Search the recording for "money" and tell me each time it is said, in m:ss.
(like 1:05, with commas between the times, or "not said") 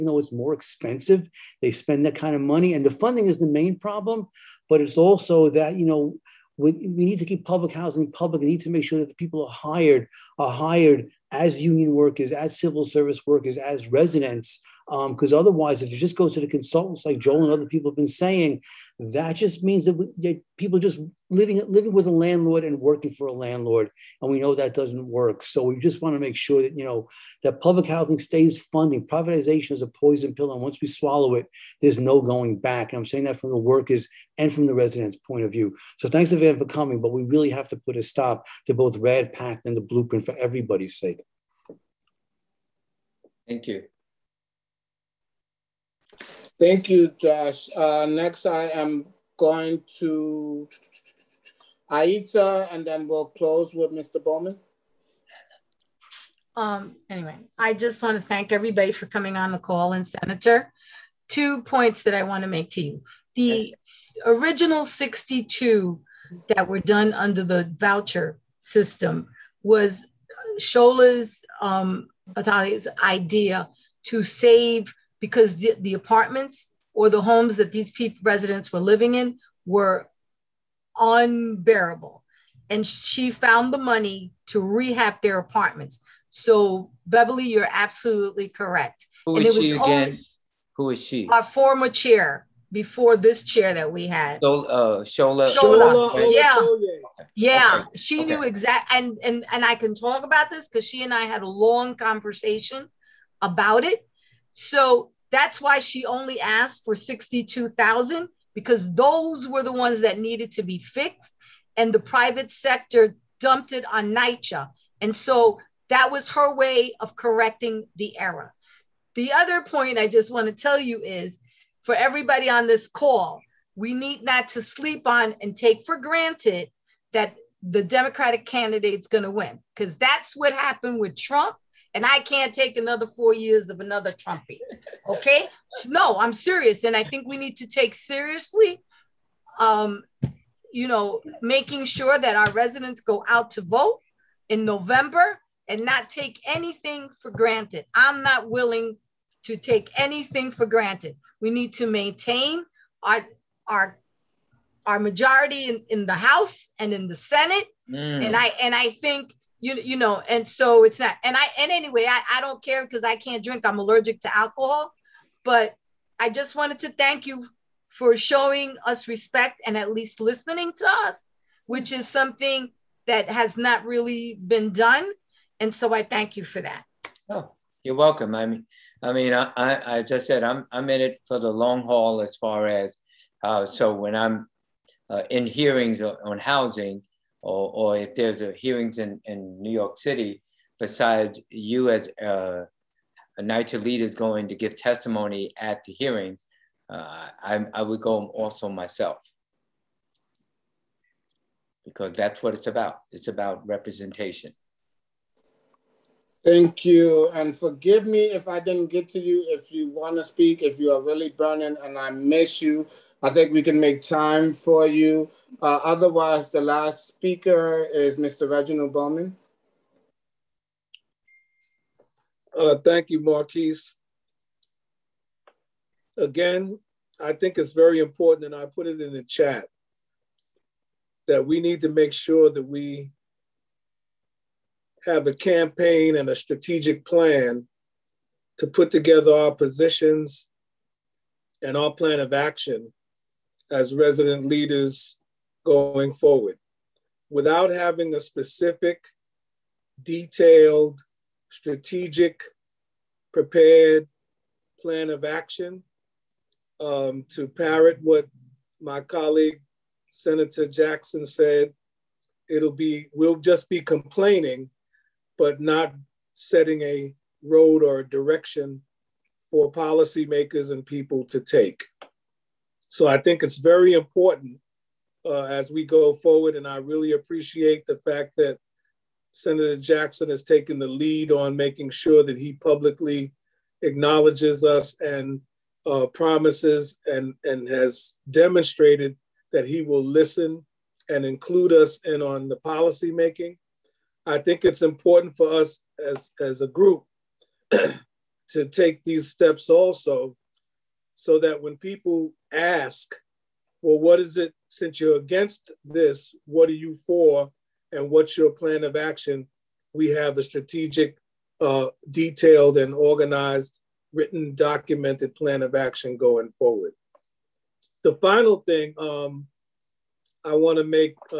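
0:02, 1:23.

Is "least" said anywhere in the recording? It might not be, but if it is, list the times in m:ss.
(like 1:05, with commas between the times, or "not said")
2:49.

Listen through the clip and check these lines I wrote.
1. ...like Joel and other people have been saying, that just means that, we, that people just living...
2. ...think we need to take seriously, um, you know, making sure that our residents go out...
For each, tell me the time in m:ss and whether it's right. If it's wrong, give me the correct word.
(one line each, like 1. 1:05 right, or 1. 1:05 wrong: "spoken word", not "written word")
1. 0:17 right
2. 2:17 right.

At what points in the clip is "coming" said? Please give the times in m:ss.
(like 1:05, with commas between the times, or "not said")
0:36, 0:59.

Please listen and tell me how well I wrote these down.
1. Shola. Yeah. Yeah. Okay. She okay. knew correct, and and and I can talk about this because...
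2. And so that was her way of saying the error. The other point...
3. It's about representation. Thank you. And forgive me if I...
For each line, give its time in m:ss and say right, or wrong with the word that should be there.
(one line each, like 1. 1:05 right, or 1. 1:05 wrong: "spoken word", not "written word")
1. 1:35 wrong: "exact", not "correct"
2. 1:55 wrong: "correcting", not "saying"
3. 3:23 right.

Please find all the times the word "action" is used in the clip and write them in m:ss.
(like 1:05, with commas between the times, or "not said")
4:02, 4:15, 5:08, 5:15.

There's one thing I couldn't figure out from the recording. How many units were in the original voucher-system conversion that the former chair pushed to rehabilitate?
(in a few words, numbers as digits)
62,000.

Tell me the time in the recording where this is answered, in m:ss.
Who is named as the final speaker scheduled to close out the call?
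3:38.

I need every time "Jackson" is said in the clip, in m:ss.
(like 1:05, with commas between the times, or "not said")
4:20, 4:39.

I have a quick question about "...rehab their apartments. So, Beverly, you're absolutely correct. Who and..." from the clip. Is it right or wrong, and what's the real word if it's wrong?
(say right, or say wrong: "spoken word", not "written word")
right.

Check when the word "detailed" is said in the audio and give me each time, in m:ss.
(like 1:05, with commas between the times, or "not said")
4:10, 5:12.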